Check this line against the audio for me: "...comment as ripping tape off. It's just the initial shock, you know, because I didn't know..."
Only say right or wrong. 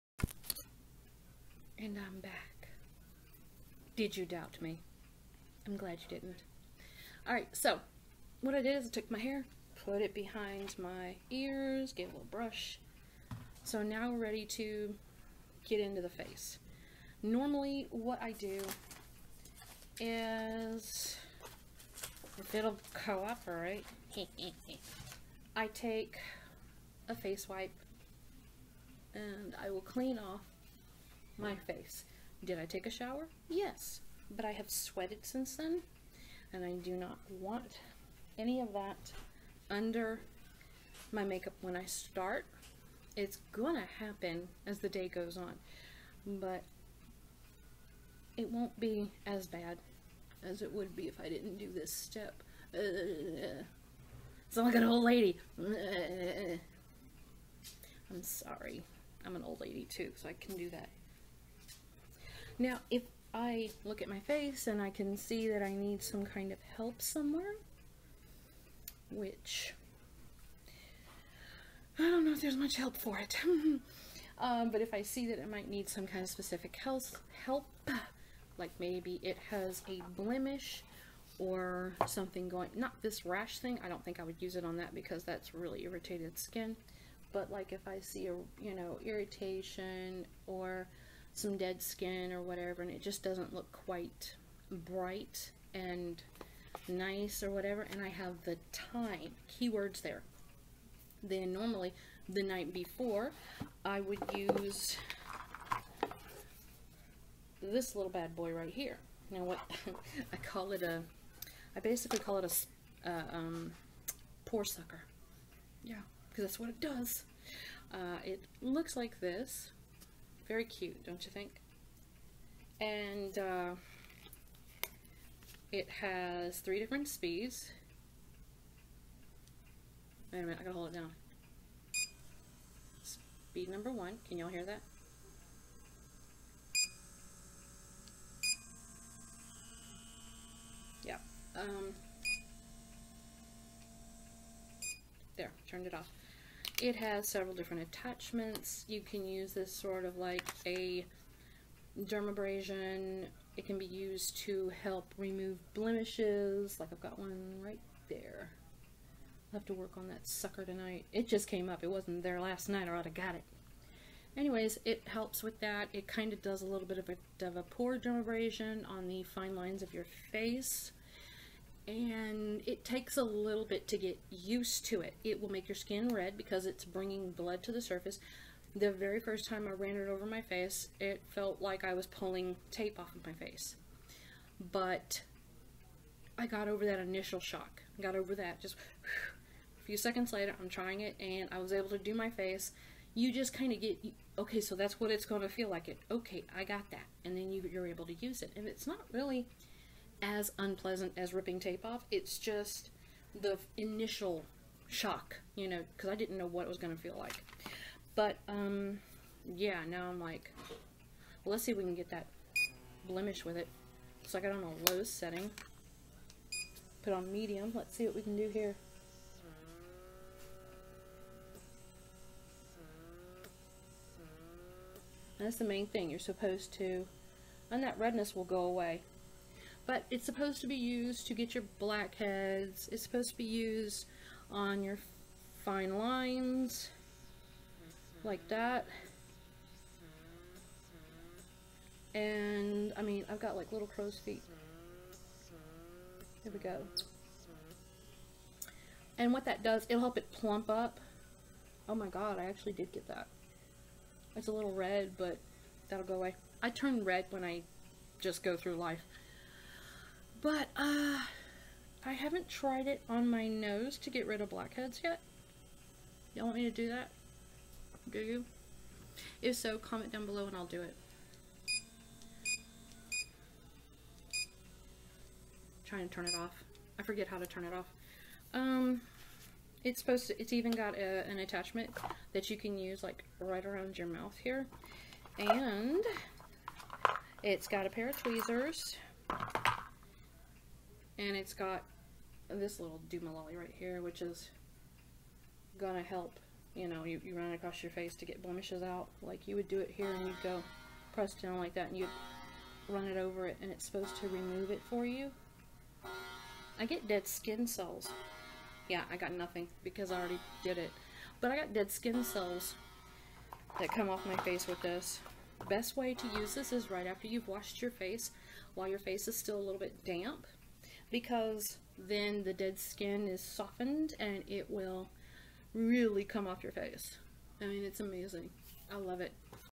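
wrong.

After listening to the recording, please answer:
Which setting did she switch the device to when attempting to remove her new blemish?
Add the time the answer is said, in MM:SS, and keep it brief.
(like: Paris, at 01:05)
Medium, at 03:37.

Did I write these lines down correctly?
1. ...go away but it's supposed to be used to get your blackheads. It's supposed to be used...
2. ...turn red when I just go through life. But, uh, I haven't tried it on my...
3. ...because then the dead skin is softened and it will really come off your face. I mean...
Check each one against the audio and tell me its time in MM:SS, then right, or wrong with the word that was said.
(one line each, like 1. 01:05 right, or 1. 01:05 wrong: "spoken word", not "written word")
1. 03:48 right
2. 04:16 right
3. 05:21 right.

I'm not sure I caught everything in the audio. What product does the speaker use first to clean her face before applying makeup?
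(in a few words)
Face wipe.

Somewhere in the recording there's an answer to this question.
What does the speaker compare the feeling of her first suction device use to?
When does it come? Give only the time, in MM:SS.
03:02.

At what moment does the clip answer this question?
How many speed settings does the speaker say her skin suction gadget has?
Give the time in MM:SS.
02:06.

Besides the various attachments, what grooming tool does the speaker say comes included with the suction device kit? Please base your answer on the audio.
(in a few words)
Tweezers.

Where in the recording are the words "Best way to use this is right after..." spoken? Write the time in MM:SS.
05:15.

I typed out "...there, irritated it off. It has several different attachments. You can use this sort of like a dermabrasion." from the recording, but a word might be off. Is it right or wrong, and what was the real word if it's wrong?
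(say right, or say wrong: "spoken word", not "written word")
wrong: "turned", not "irritated".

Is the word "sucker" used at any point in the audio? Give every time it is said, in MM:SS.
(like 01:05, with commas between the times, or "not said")
01:54, 02:40.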